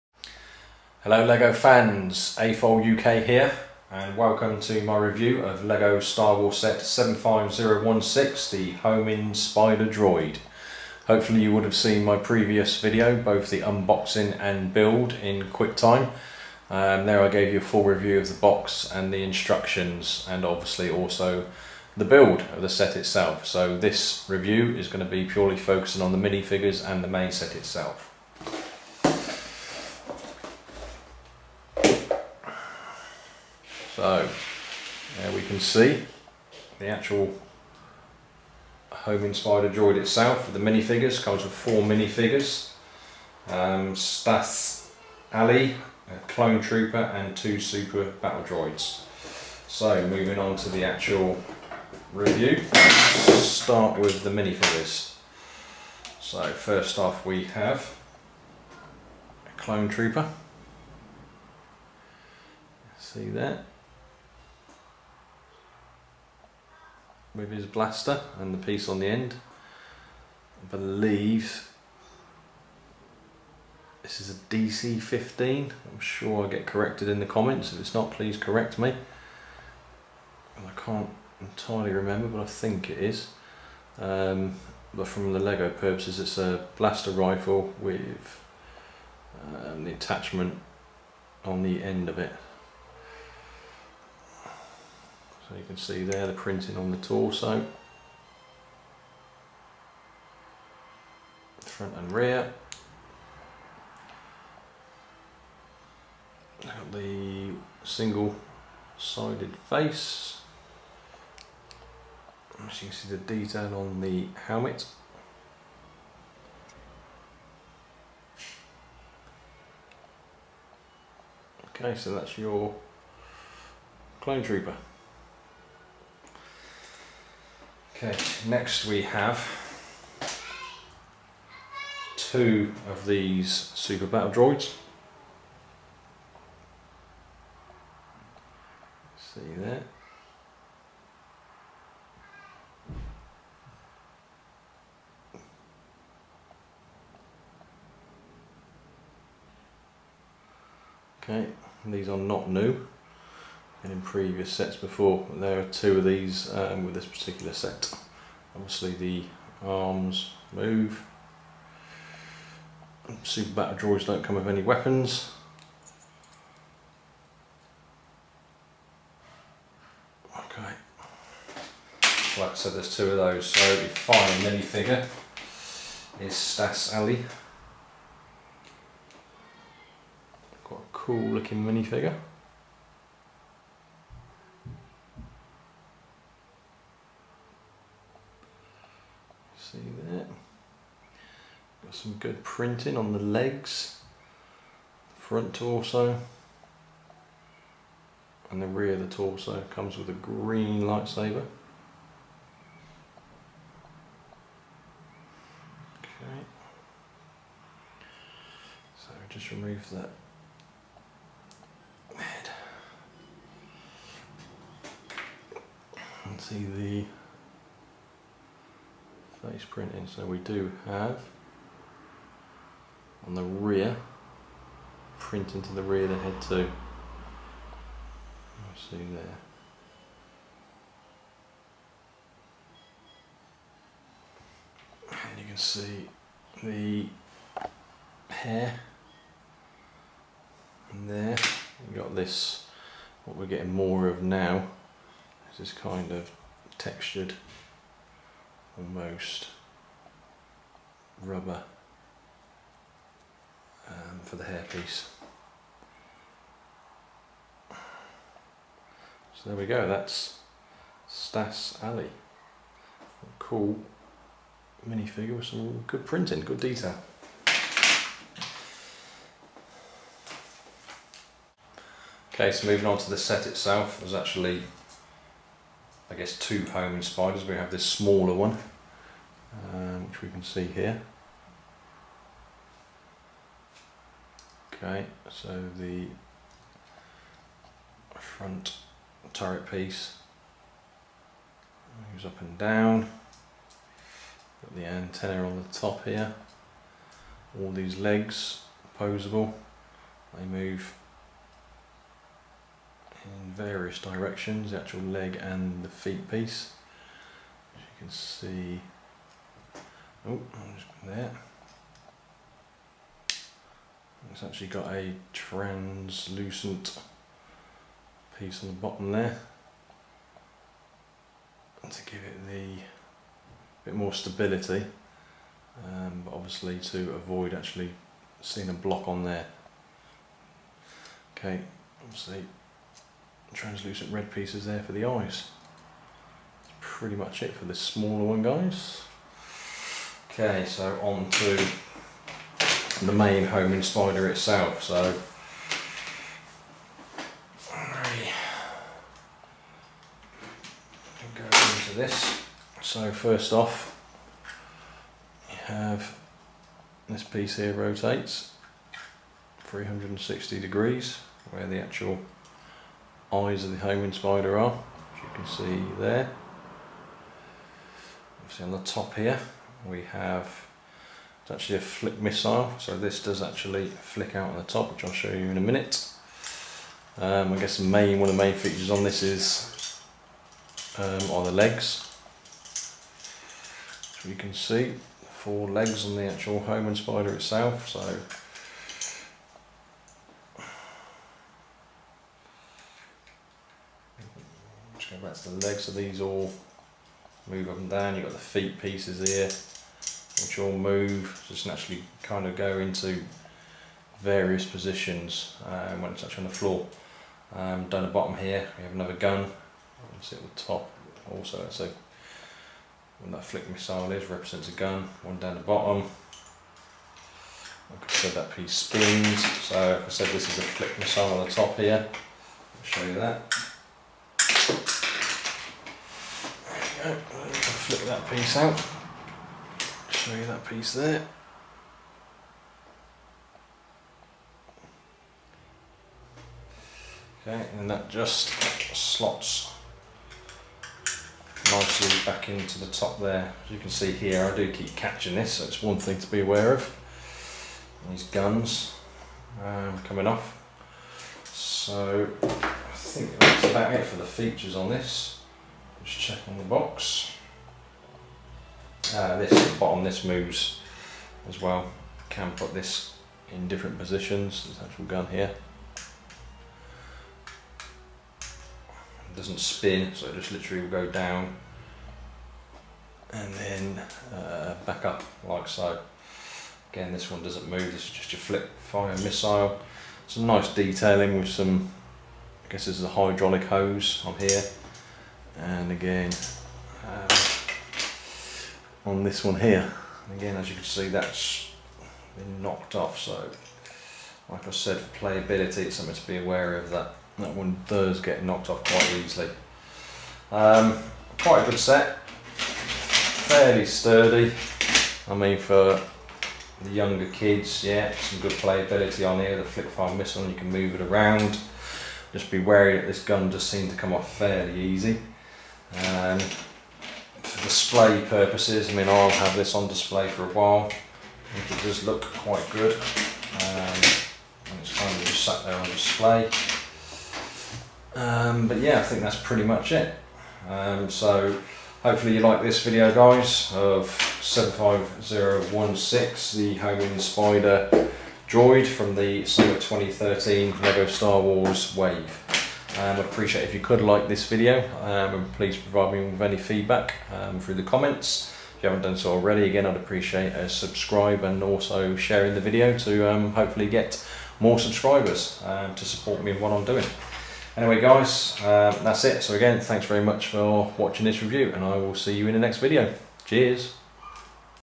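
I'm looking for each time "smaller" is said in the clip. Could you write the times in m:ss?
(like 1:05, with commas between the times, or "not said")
4:37, 5:37.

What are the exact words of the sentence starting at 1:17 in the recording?
If it's not, please correct me.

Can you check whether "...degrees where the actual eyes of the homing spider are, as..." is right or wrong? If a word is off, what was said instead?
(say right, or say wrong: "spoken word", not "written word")
right.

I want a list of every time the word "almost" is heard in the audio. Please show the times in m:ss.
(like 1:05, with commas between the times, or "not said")
4:08.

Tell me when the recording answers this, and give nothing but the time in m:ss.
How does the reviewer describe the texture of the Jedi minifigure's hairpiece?
4:11.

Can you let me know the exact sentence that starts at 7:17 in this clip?
Okay, and that just slots nicely back into the top there.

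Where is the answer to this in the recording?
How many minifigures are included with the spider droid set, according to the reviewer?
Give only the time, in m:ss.
0:41.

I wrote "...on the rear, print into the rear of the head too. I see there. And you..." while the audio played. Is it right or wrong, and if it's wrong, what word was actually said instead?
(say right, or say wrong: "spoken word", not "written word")
right.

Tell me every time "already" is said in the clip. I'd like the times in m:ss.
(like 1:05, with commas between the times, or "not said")
9:09.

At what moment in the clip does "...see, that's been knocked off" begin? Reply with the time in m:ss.
8:10.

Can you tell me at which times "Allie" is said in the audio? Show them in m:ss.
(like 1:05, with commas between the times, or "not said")
0:45, 2:56, 4:21.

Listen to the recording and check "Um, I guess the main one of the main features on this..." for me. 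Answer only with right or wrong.
right.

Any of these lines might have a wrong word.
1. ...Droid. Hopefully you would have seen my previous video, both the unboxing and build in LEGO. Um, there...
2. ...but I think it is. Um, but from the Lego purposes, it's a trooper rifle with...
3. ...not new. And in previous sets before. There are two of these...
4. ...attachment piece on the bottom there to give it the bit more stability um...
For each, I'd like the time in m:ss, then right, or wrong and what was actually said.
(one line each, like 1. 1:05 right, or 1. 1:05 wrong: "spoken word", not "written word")
1. 0:09 wrong: "QuickTime", not "LEGO"
2. 1:22 wrong: "blaster", not "trooper"
3. 2:32 right
4. 5:15 wrong: "translucent", not "attachment".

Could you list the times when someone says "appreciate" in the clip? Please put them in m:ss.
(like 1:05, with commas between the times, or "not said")
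9:03, 9:09.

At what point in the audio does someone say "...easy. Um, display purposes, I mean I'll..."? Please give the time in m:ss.
8:34.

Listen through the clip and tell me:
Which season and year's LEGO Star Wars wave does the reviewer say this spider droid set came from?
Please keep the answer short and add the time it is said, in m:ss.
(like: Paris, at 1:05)
Summer 2013, at 8:59.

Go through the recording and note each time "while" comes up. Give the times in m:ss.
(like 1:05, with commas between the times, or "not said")
8:40.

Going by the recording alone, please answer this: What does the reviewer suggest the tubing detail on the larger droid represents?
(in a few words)
Hydraulic hose.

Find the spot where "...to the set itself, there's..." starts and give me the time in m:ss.
4:32.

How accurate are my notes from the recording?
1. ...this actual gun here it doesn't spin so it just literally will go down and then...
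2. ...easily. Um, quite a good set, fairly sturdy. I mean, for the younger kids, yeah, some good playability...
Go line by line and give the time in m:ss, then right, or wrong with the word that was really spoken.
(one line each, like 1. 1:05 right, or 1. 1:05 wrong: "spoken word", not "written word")
1. 7:44 right
2. 8:19 right.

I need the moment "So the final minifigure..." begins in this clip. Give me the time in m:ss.
2:53.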